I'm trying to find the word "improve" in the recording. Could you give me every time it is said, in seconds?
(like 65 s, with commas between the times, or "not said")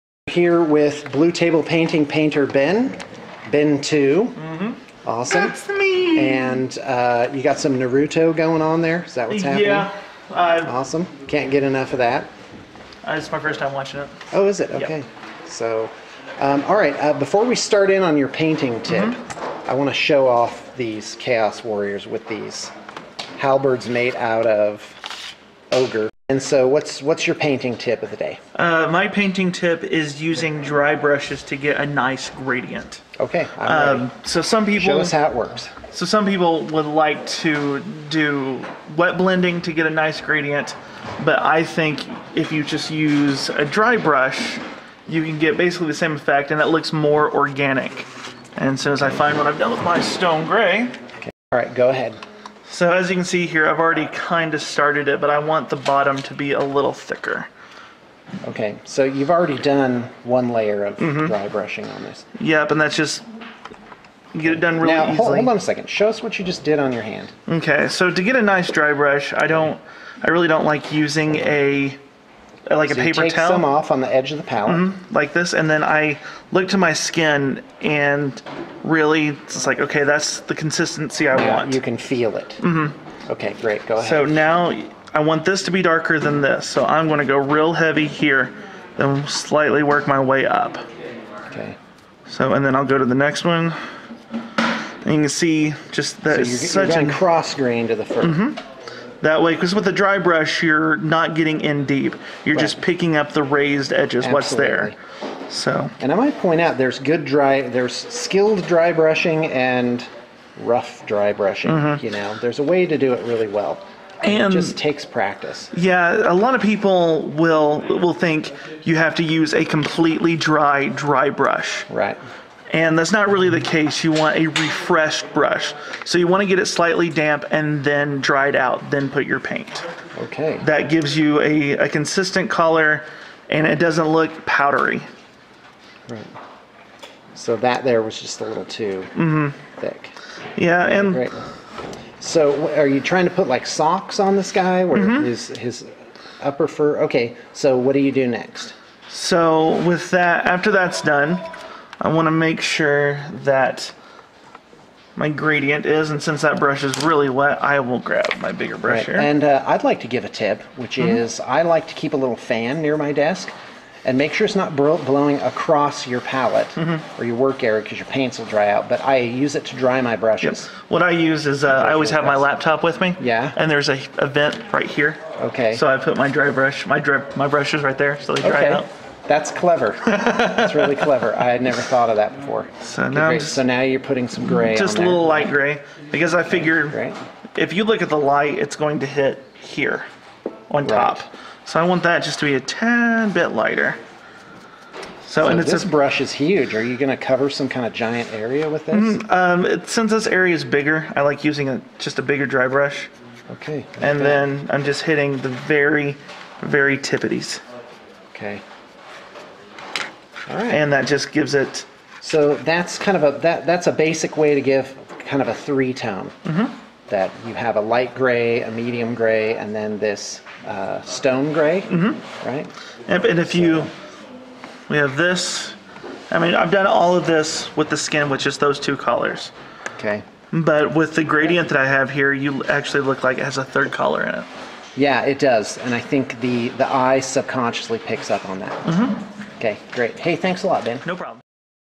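not said.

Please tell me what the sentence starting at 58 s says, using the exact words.
Okay, so you've already done one layer of mm -hmm.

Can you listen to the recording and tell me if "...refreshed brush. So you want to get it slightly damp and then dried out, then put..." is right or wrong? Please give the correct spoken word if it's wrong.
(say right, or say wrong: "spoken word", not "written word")
right.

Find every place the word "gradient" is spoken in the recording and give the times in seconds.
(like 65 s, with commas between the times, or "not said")
32 s, 40 s, 155 s, 231 s.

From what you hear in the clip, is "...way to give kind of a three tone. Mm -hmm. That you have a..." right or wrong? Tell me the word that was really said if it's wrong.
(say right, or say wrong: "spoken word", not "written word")
right.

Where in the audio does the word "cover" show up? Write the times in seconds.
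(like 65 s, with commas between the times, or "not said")
197 s.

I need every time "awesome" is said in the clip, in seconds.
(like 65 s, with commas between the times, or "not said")
5 s, 10 s.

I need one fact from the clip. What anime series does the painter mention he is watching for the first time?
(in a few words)
Naruto.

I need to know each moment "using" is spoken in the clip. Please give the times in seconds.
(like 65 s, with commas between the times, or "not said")
30 s, 71 s, 201 s.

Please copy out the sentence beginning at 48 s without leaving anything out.
And so as I find what I've done with my stone gray.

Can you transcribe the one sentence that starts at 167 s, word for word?
or your work area because your paints will dry out.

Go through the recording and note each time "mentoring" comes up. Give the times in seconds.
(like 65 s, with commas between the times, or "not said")
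not said.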